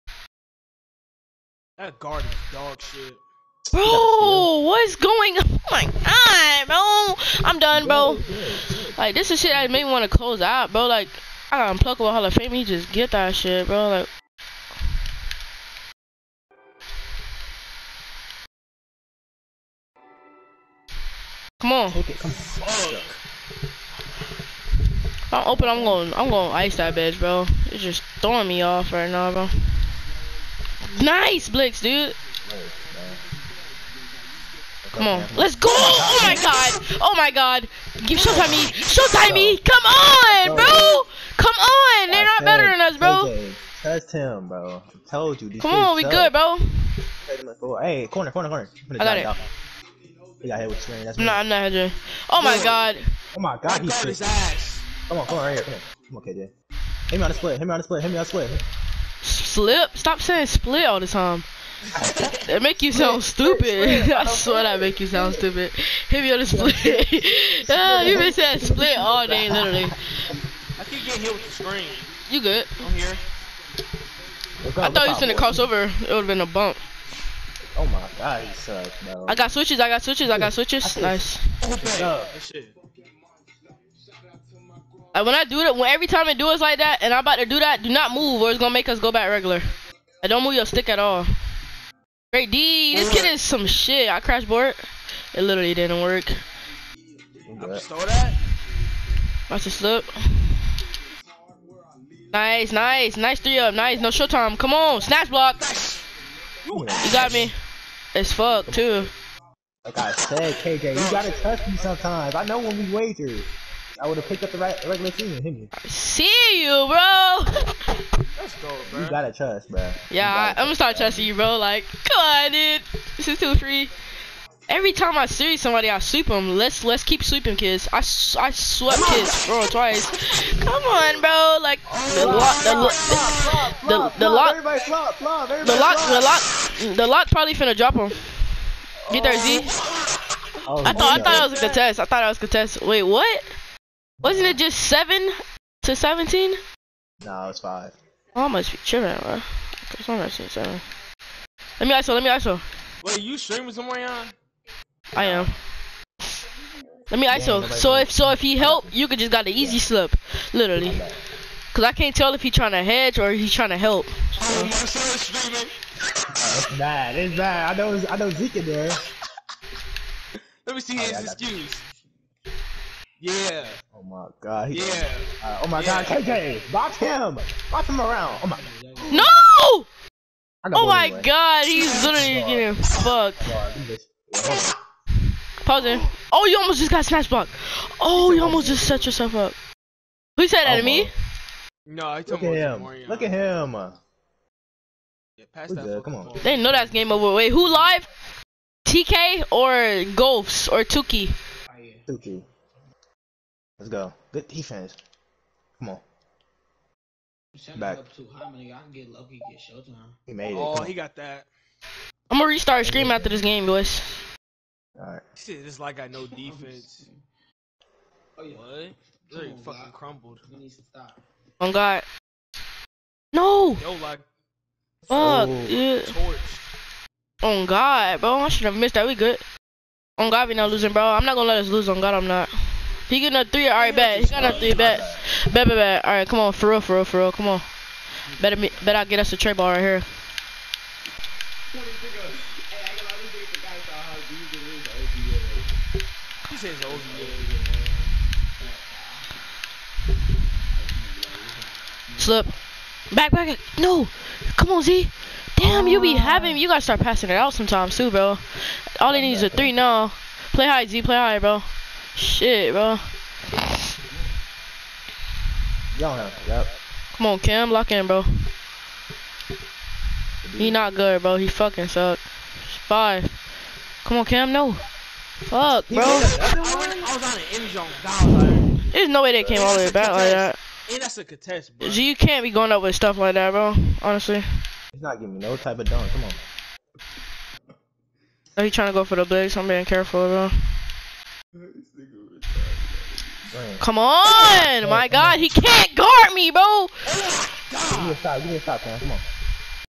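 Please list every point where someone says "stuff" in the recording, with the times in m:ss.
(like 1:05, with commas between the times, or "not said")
4:42.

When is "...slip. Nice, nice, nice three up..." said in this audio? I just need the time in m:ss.
1:39.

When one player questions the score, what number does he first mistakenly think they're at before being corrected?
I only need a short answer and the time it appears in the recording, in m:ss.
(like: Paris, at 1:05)
7, at 2:24.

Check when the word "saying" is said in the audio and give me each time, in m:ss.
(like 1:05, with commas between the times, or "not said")
1:00, 1:08.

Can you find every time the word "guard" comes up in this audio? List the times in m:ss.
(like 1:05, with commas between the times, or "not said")
0:01, 4:55.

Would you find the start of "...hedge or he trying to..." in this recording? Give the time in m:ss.
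2:42.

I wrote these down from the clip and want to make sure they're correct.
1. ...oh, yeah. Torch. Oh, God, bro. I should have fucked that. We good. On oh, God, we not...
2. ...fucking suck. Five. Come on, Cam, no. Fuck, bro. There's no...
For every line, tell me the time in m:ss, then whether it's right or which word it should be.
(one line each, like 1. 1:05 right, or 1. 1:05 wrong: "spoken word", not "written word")
1. 3:45 wrong: "missed", not "fucked"
2. 4:31 right.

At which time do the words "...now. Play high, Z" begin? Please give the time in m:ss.
4:19.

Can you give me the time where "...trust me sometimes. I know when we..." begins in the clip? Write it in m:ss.
1:51.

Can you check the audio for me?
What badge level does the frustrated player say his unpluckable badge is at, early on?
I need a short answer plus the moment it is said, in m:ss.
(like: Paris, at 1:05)
Hall of Fame, at 0:11.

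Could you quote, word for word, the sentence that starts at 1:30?
I don't move your stick at all.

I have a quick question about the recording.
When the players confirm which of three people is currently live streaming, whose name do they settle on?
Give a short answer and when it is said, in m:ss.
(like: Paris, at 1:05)
Tuki, at 3:22.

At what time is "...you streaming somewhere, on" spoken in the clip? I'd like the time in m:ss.
2:33.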